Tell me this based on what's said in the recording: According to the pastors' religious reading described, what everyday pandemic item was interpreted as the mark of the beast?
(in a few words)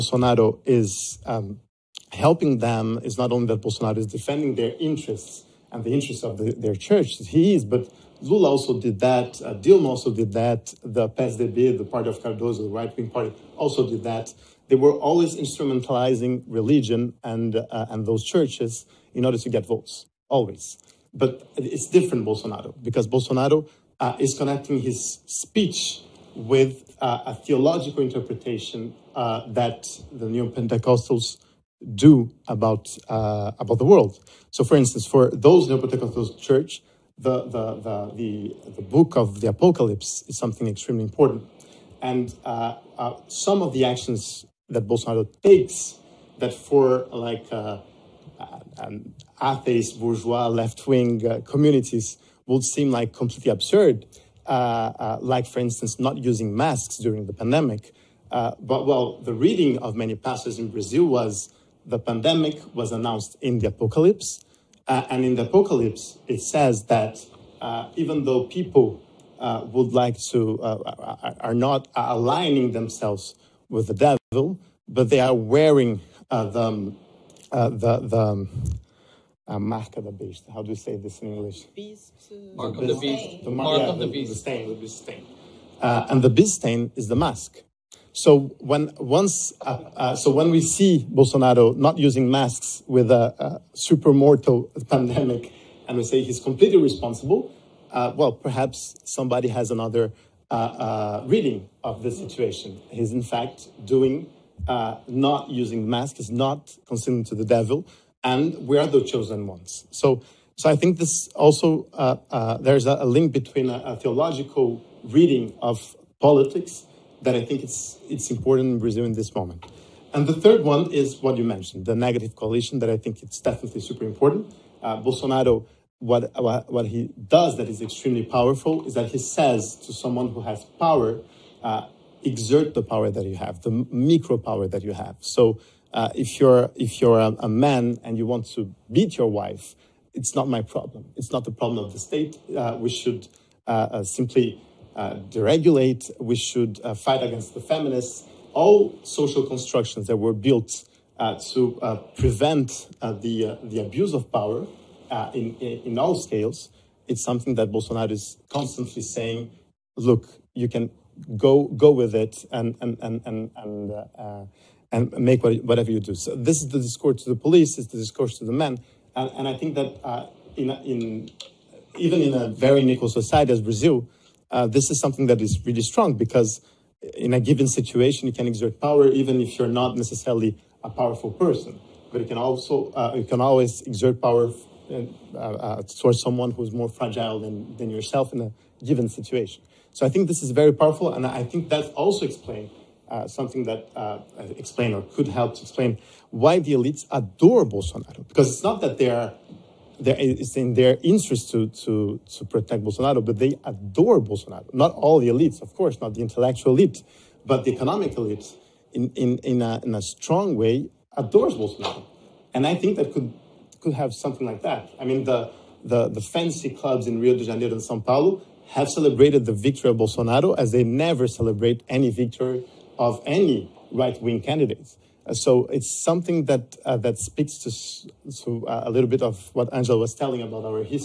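The mask.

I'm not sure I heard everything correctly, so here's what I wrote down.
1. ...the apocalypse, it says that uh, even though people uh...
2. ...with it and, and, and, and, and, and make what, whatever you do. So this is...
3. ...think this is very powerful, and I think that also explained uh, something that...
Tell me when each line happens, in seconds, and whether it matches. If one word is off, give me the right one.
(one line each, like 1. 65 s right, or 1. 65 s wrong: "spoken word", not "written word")
1. 65 s right
2. 161 s right
3. 190 s right.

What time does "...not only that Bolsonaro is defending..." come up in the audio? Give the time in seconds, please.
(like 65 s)
3 s.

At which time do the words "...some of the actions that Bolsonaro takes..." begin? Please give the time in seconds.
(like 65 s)
43 s.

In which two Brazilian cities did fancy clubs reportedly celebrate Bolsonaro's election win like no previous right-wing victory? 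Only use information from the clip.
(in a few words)
Rio de Janeiro and Sao Paulo.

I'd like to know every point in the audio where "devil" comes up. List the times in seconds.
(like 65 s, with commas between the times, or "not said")
74 s, 107 s.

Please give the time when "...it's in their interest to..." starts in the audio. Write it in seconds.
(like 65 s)
200 s.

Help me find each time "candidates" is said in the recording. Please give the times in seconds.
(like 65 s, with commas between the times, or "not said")
224 s.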